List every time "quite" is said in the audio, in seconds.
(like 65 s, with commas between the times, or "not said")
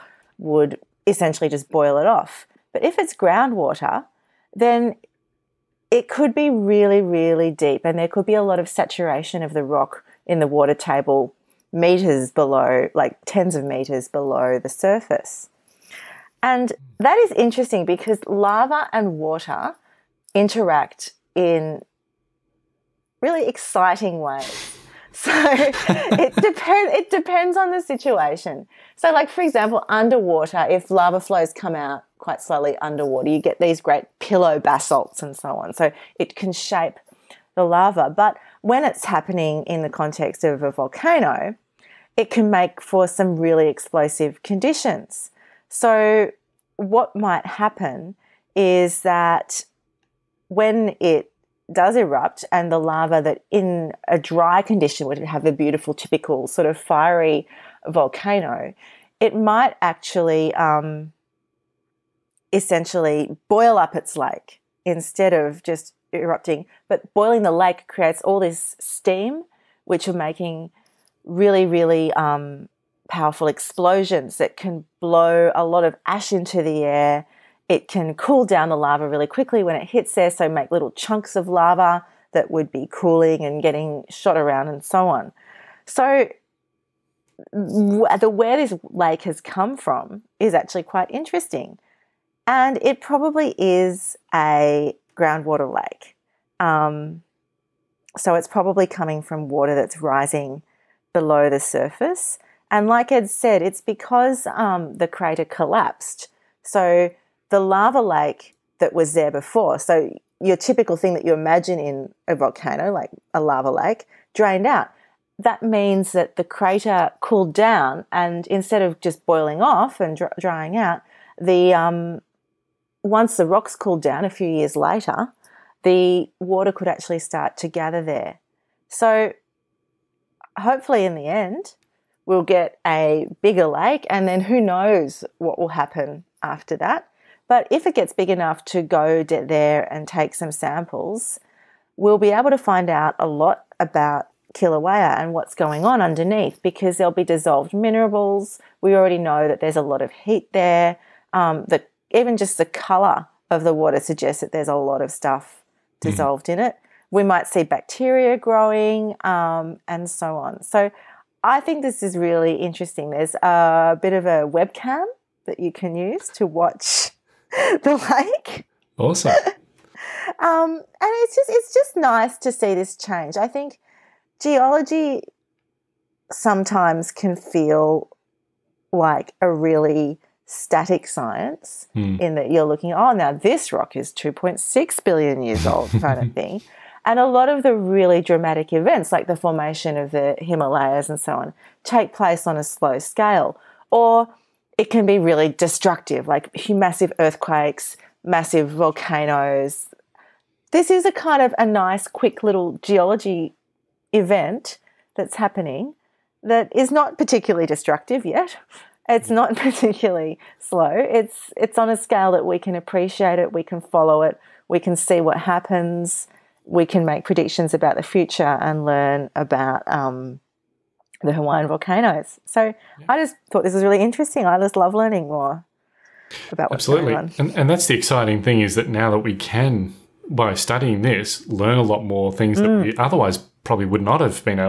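32 s, 90 s.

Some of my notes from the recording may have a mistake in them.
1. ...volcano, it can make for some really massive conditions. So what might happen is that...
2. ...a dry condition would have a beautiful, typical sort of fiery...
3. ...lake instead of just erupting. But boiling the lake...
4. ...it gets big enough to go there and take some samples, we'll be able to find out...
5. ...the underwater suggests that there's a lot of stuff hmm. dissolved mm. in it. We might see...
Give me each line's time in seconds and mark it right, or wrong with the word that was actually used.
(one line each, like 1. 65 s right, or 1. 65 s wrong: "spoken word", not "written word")
1. 40 s wrong: "explosive", not "massive"
2. 54 s right
3. 64 s right
4. 137 s right
5. 153 s wrong: "water", not "underwater".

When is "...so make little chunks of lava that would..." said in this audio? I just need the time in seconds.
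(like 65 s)
80 s.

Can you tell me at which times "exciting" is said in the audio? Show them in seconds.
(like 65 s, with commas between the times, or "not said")
23 s, 227 s.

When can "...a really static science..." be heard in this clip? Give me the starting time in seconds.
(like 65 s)
179 s.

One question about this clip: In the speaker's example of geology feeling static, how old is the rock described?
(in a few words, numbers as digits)
2.6 billion years.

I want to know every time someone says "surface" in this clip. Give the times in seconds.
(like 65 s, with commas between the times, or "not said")
14 s, 101 s.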